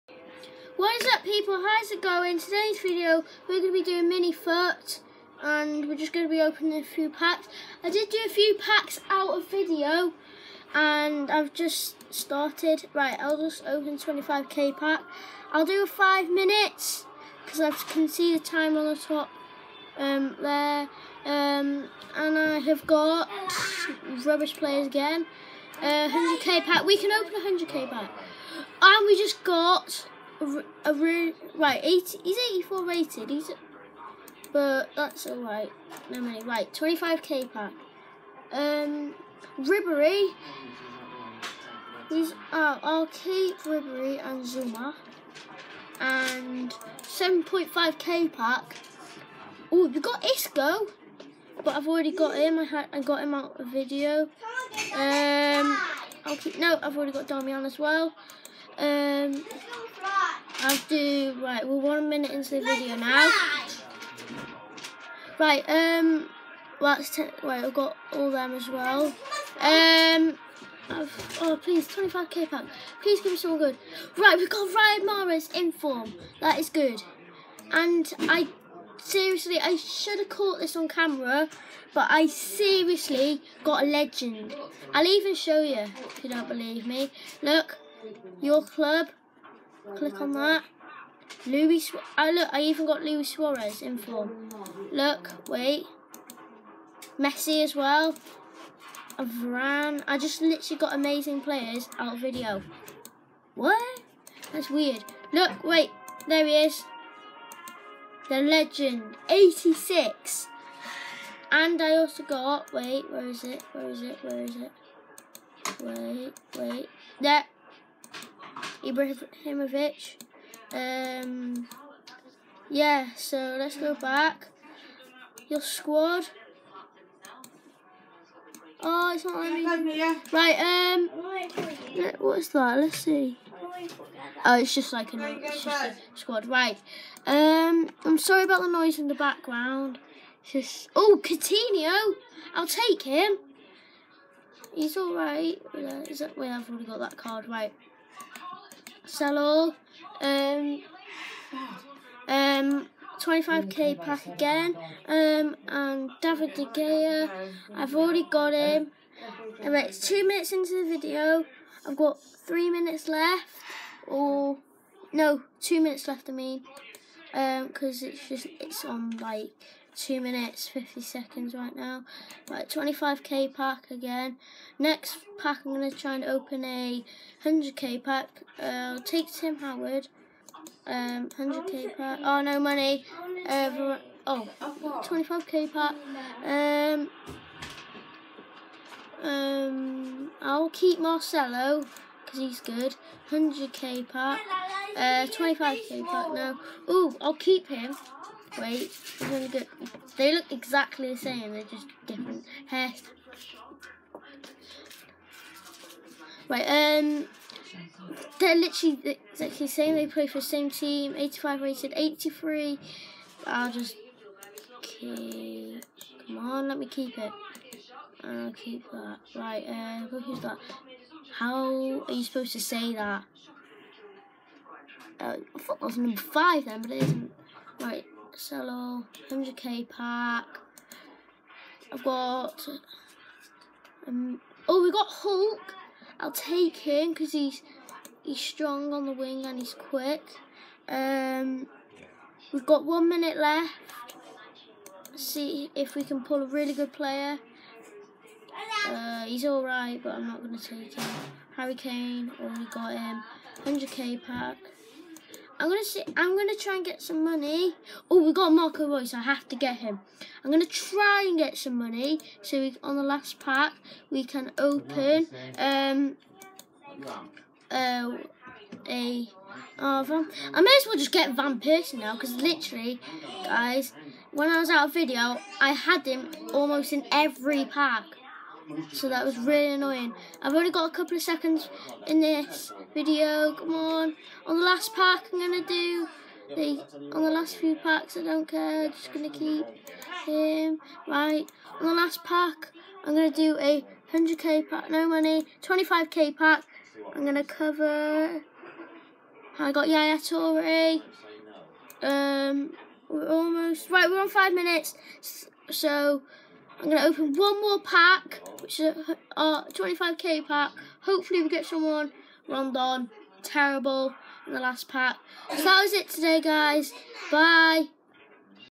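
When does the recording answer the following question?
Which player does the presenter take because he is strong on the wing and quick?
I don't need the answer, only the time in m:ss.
3:55.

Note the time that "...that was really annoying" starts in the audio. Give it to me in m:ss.
4:39.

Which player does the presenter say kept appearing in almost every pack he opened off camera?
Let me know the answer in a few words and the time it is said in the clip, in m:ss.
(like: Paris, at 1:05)
Van Persie, at 4:31.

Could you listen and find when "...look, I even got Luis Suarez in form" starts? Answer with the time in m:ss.
1:32.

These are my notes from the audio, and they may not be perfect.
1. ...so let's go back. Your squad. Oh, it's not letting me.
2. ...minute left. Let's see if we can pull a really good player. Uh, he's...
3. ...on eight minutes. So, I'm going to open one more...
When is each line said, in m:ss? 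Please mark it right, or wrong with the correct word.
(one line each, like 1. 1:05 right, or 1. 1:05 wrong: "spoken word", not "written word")
1. 2:03 right
2. 4:03 right
3. 5:04 wrong: "five", not "eight".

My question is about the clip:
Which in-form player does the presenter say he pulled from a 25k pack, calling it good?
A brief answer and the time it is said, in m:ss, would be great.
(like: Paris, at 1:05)
Ryan Morris, at 1:14.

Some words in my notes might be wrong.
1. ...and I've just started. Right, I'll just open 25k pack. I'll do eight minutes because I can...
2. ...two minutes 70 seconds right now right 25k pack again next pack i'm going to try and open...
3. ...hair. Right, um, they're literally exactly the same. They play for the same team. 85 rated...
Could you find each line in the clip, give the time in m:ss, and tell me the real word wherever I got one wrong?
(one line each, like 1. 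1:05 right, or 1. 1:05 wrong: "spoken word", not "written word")
1. 0:10 wrong: "five", not "eight"
2. 2:49 wrong: "50", not "70"
3. 3:22 right.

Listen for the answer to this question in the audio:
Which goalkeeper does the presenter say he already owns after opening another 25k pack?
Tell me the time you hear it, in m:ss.
2:36.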